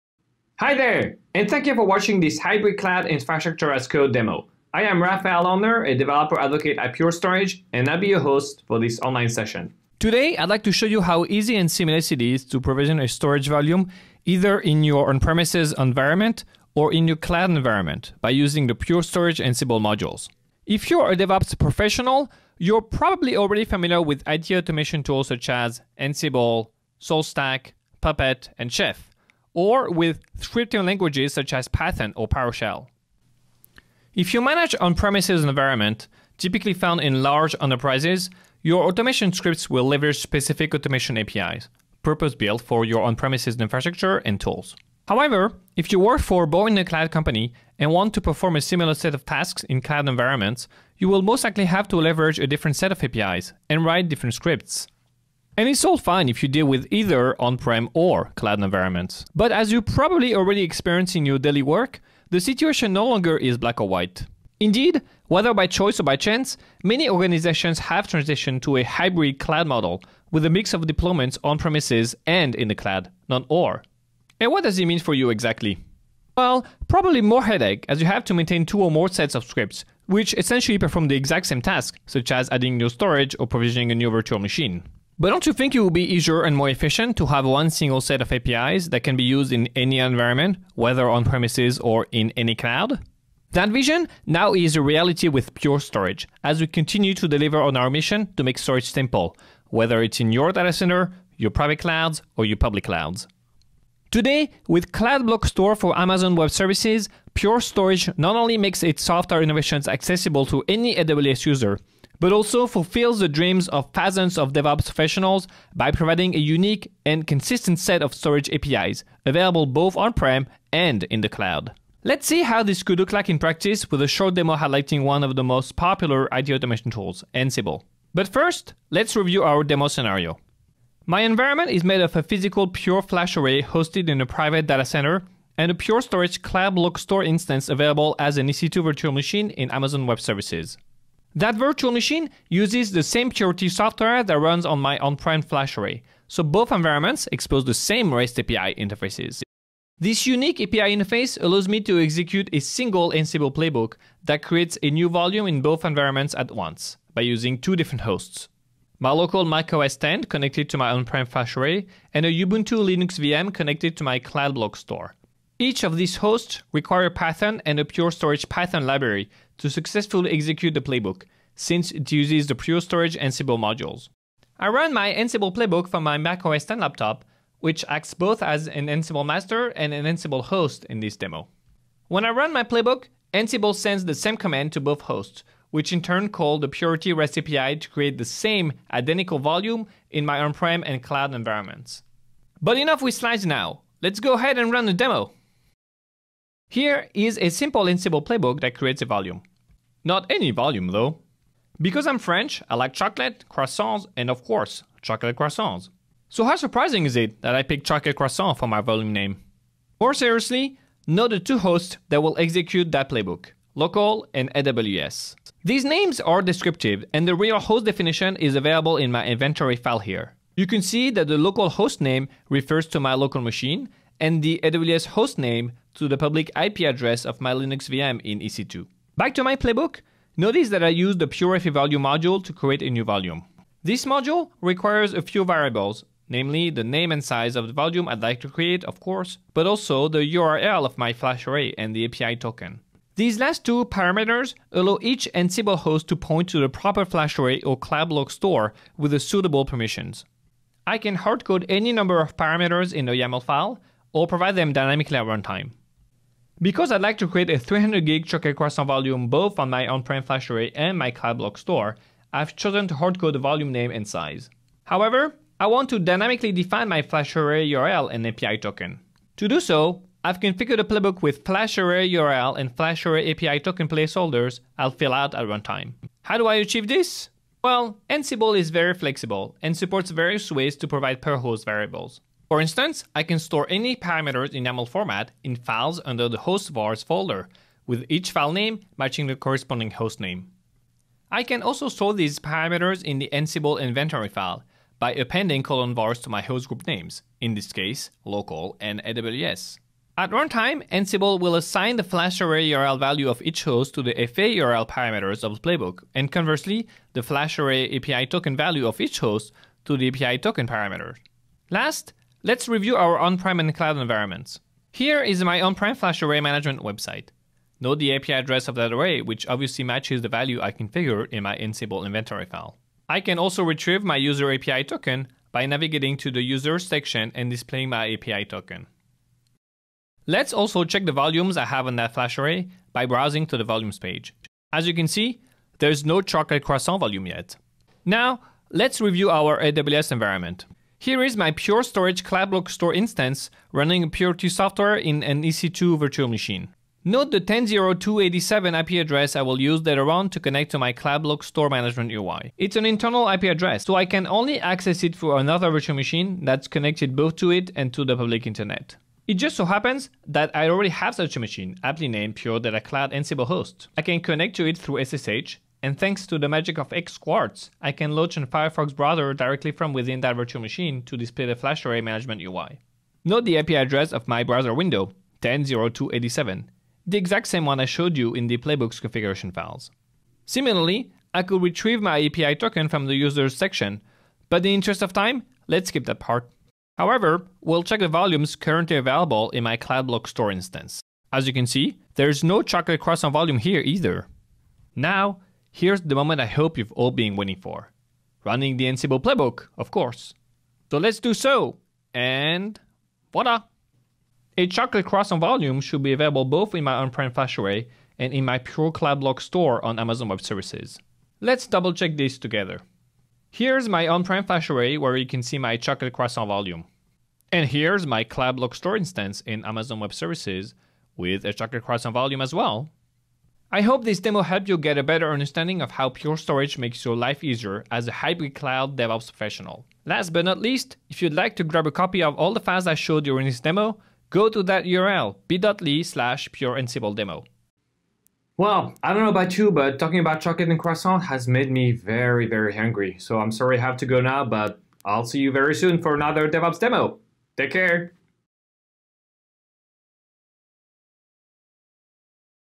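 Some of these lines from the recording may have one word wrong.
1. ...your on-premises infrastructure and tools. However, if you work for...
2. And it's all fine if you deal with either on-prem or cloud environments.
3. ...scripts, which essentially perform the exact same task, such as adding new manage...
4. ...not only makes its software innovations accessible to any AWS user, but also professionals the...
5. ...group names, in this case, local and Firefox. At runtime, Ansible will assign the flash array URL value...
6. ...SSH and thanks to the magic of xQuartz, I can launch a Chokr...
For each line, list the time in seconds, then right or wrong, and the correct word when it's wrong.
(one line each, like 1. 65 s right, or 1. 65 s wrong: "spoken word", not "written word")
1. 42 s right
2. 55 s right
3. 79 s wrong: "storage", not "manage"
4. 108 s wrong: "fulfills", not "professionals"
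5. 296 s wrong: "AWS", not "Firefox"
6. 365 s wrong: "Firefox", not "Chokr".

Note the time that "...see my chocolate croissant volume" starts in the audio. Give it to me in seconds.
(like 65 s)
415 s.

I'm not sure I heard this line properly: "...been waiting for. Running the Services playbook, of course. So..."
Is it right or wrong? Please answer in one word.
wrong.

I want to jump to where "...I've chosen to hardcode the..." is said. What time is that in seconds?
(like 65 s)
262 s.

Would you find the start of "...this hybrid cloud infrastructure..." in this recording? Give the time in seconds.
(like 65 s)
2 s.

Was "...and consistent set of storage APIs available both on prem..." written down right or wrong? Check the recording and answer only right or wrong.
right.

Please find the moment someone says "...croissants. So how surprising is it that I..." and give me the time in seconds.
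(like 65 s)
205 s.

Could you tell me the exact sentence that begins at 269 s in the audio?
To do so, I've configured a playbook with flash array URL and flash array API token placeholders I'll fill out at runtime.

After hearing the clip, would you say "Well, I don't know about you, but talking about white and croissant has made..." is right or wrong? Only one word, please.
wrong.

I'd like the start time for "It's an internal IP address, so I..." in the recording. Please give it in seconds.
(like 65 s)
352 s.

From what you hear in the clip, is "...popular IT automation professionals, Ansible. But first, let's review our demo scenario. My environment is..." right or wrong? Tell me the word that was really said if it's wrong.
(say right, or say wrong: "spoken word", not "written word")
wrong: "tools", not "professionals".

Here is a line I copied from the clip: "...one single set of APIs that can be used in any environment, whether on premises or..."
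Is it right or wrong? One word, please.
right.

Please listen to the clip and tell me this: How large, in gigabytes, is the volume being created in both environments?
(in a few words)
300.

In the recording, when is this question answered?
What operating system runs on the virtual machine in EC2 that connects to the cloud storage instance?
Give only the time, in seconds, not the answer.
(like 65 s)
162 s.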